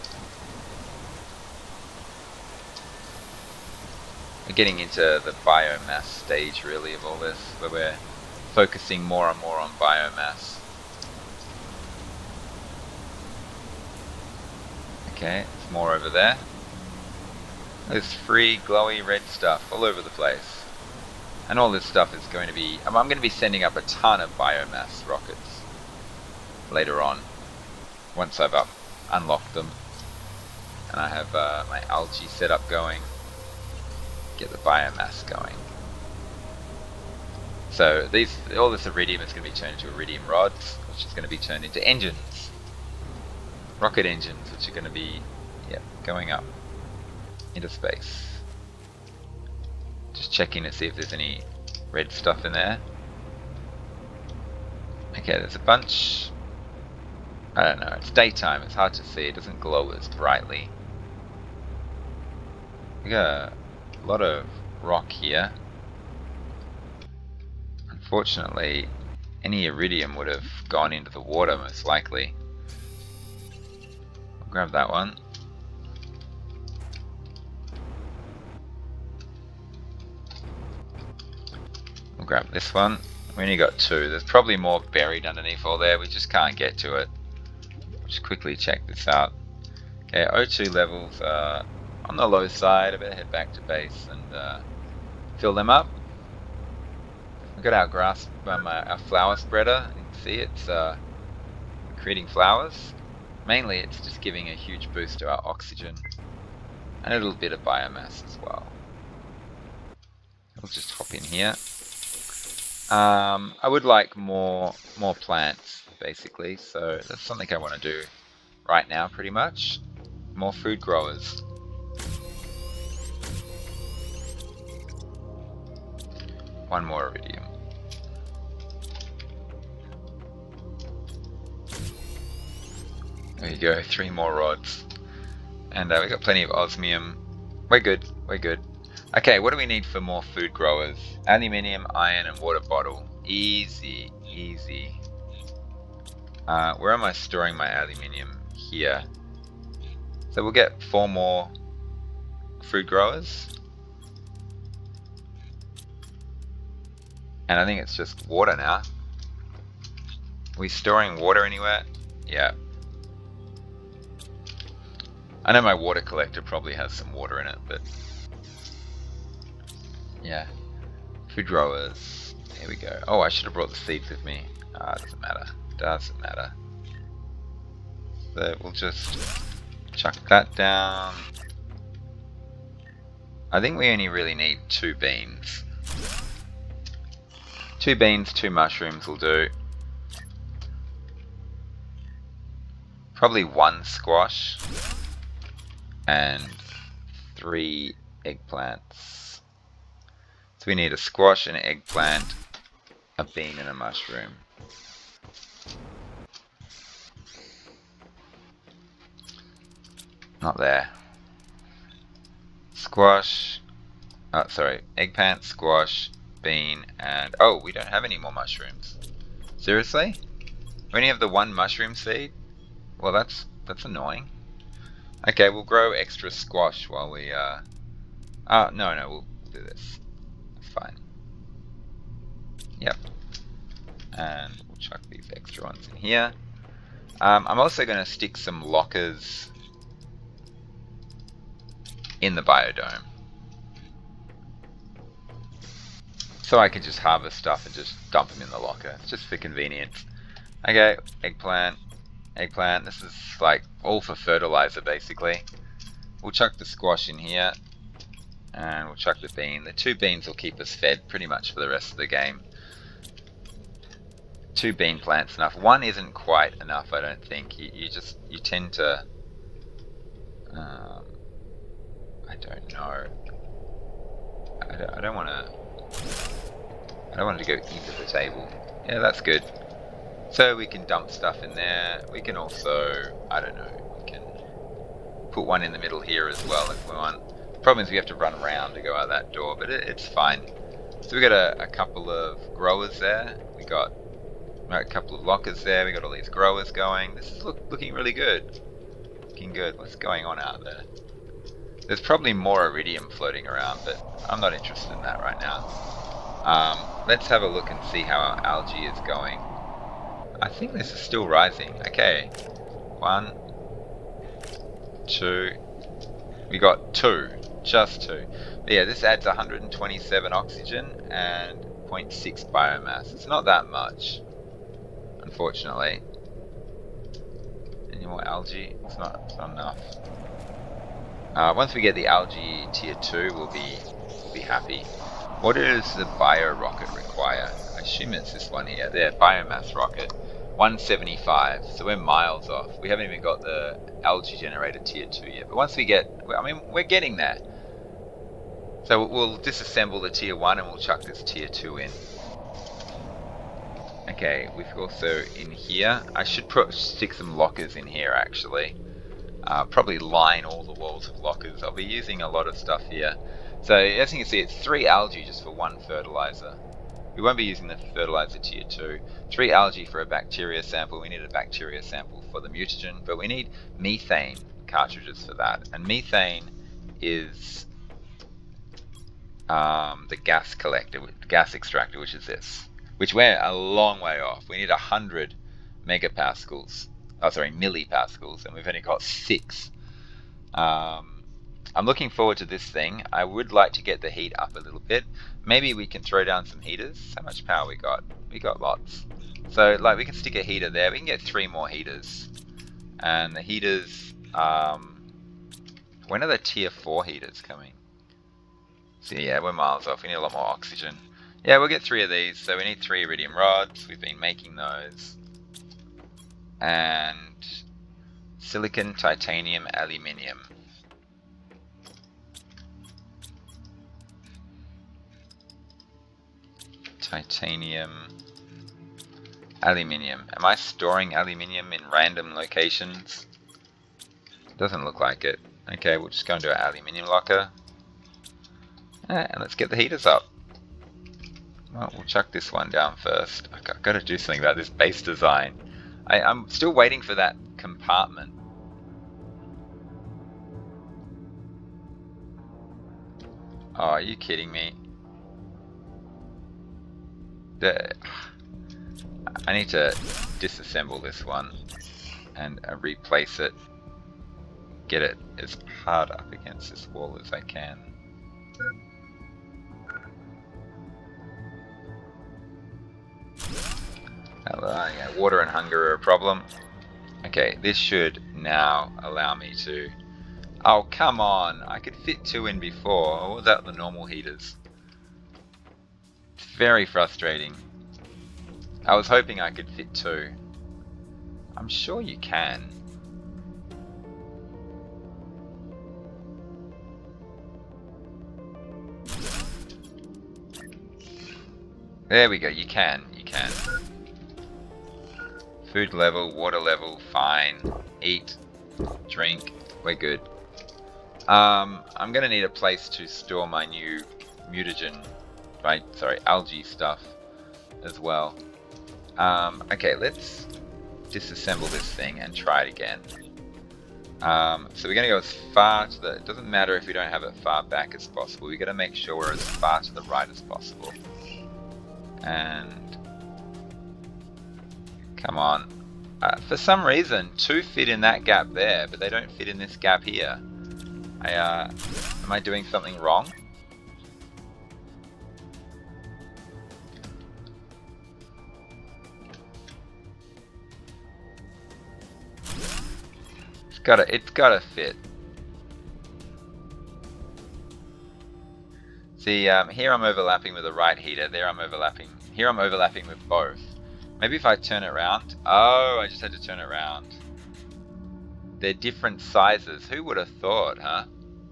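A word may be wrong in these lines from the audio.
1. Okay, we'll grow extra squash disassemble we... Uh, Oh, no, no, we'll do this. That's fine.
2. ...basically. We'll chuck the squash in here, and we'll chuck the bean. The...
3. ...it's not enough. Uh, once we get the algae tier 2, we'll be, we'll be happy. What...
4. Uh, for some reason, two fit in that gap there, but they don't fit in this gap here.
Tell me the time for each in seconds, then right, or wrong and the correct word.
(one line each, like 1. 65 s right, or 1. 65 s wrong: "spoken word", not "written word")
1. 225 s wrong: "while", not "disassemble"
2. 254 s right
3. 329 s right
4. 536 s right.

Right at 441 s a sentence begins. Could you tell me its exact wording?
Well, we'll chuck this one down first.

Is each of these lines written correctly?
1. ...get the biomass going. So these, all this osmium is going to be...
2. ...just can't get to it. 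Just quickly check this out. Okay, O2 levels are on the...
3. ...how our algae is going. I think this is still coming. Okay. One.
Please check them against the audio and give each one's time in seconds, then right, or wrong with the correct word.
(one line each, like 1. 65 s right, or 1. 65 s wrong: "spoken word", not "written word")
1. 34 s wrong: "iridium", not "osmium"
2. 86 s right
3. 308 s wrong: "rising", not "coming".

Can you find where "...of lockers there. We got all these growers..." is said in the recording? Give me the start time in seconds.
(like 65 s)
295 s.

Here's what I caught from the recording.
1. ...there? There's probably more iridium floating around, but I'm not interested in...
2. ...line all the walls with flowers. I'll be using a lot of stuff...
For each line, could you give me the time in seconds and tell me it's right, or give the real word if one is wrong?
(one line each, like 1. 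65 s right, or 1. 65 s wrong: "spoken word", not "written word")
1. 300 s right
2. 359 s wrong: "lockers", not "flowers".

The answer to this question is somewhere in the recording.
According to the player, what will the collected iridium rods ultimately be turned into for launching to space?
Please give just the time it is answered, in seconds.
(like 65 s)
43 s.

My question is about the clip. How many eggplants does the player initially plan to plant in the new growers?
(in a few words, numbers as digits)
3.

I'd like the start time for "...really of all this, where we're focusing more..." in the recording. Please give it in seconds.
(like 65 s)
6 s.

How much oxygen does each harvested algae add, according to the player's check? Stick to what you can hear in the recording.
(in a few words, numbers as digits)
127.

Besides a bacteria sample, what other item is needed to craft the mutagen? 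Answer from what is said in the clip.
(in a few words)
Methane cartridges.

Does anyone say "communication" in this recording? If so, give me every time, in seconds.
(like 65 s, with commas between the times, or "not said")
not said.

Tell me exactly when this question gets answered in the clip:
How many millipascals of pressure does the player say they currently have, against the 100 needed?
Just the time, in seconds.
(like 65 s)
389 s.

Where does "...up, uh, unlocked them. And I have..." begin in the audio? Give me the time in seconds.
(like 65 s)
28 s.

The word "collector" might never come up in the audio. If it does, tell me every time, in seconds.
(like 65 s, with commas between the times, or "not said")
166 s, 380 s.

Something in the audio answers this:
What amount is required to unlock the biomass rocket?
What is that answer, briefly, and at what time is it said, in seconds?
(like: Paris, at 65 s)
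175, at 340 s.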